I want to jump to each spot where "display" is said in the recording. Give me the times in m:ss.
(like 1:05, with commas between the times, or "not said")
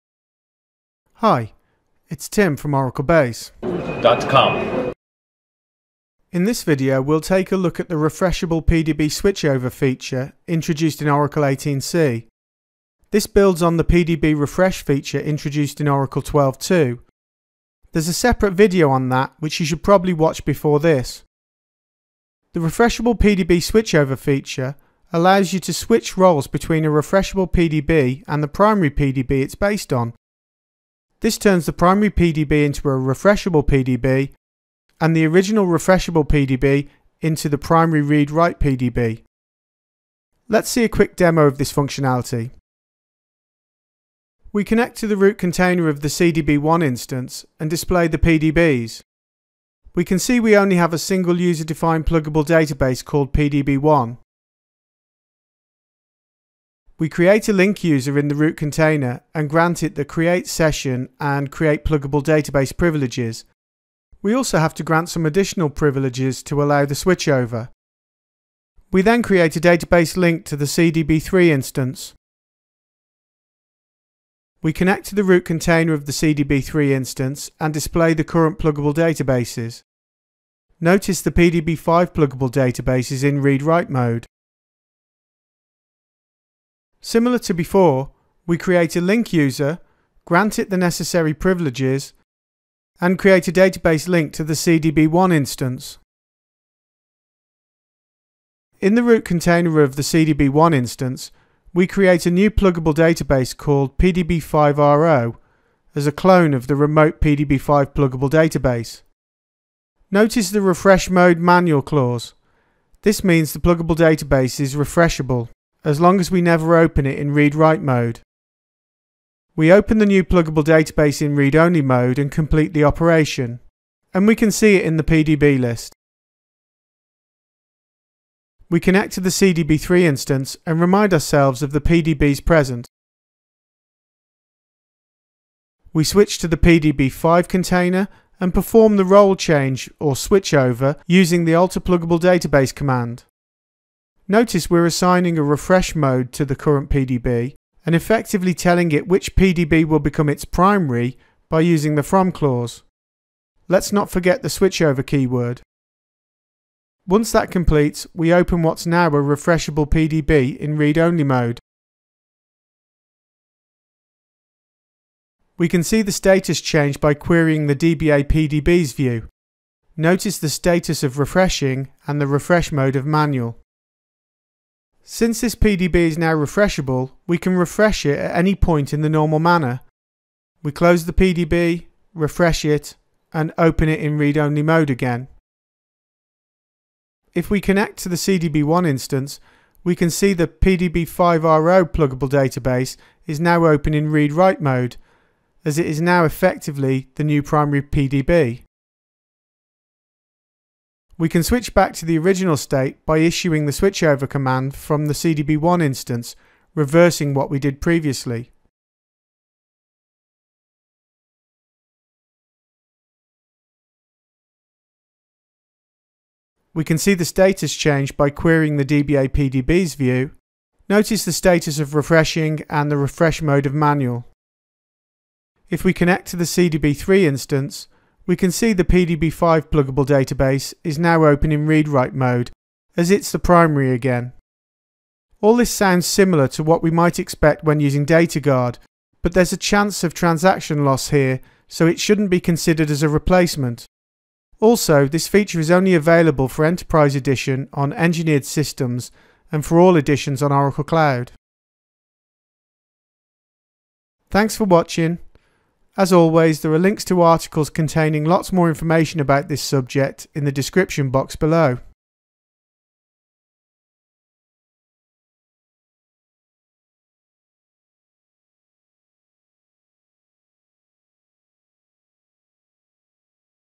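0:47, 1:17.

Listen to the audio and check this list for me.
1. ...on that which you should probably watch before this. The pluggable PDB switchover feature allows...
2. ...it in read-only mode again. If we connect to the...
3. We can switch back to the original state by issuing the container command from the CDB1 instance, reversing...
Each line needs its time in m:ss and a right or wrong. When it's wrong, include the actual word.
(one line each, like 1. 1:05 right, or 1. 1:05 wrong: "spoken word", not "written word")
1. 0:18 wrong: "refreshable", not "pluggable"
2. 3:03 right
3. 3:21 wrong: "switchover", not "container".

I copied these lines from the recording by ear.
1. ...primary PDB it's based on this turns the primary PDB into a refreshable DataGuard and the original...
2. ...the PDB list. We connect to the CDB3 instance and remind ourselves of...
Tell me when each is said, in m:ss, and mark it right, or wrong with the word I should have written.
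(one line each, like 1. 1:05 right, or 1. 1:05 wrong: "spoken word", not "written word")
1. 0:28 wrong: "PDB", not "DataGuard"
2. 2:04 right.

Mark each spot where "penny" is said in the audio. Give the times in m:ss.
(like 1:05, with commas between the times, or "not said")
not said.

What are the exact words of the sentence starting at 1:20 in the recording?
Notice the PDB5 pluggable database is in read-write mode.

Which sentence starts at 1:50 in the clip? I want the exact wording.
Notice the refresh mode manual clause.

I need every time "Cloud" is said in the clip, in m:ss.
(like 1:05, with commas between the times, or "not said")
4:10.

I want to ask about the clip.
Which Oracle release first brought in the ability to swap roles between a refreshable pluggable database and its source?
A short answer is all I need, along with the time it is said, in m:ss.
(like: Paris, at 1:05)
Oracle 18c, at 0:11.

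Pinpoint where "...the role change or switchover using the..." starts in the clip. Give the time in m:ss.
2:18.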